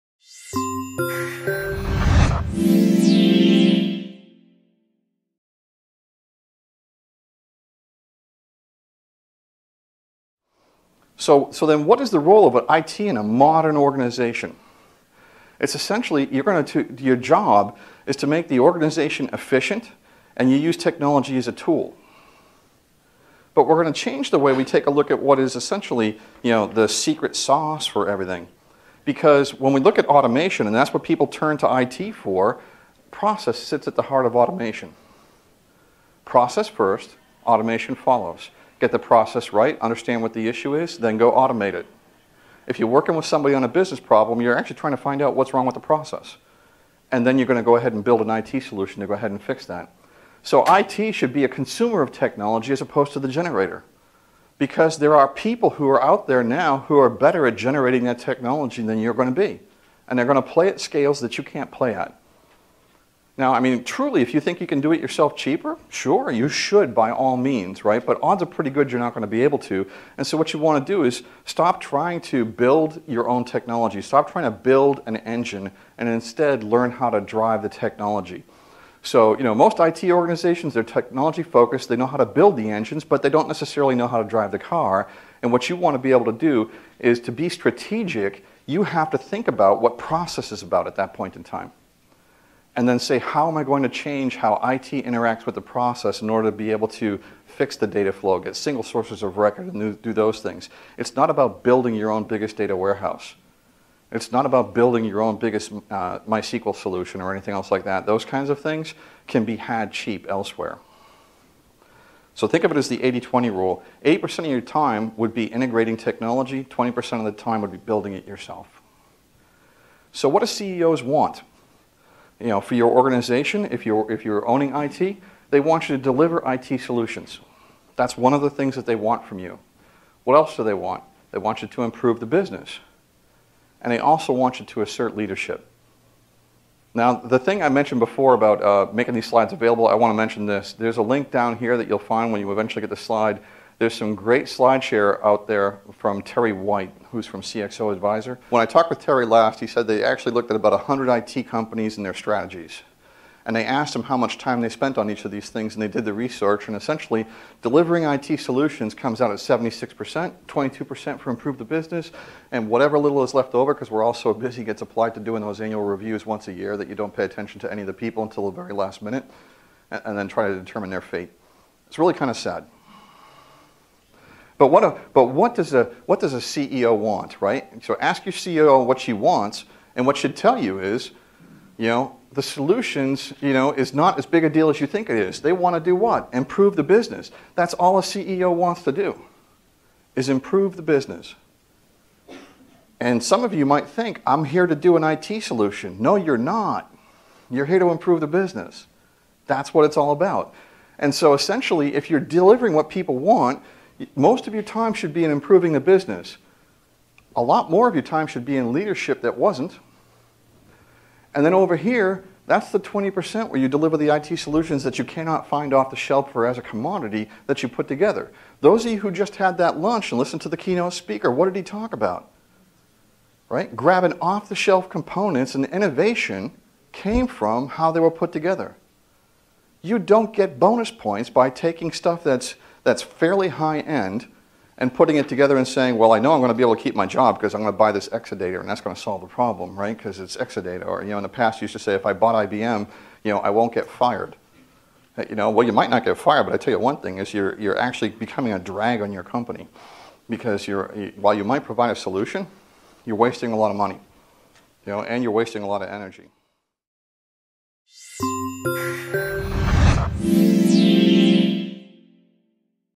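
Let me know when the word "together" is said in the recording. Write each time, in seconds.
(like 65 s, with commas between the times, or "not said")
217 s, 228 s, 235 s.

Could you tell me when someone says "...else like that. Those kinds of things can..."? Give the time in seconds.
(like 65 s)
107 s.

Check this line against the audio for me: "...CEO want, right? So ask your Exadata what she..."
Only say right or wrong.
wrong.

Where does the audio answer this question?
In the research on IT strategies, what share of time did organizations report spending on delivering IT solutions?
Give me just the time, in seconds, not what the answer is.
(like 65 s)
159 s.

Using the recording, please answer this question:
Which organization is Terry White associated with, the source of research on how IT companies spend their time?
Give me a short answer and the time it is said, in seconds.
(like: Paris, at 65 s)
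CXO Advisor, at 147 s.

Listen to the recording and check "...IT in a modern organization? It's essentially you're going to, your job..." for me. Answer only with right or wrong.
right.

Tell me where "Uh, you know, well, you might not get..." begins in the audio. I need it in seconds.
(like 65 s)
245 s.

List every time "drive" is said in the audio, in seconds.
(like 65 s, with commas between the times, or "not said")
77 s, 84 s.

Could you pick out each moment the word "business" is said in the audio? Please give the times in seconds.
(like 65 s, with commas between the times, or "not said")
43 s, 132 s, 161 s, 186 s, 190 s, 198 s, 205 s.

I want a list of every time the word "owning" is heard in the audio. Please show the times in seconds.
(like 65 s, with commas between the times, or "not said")
124 s.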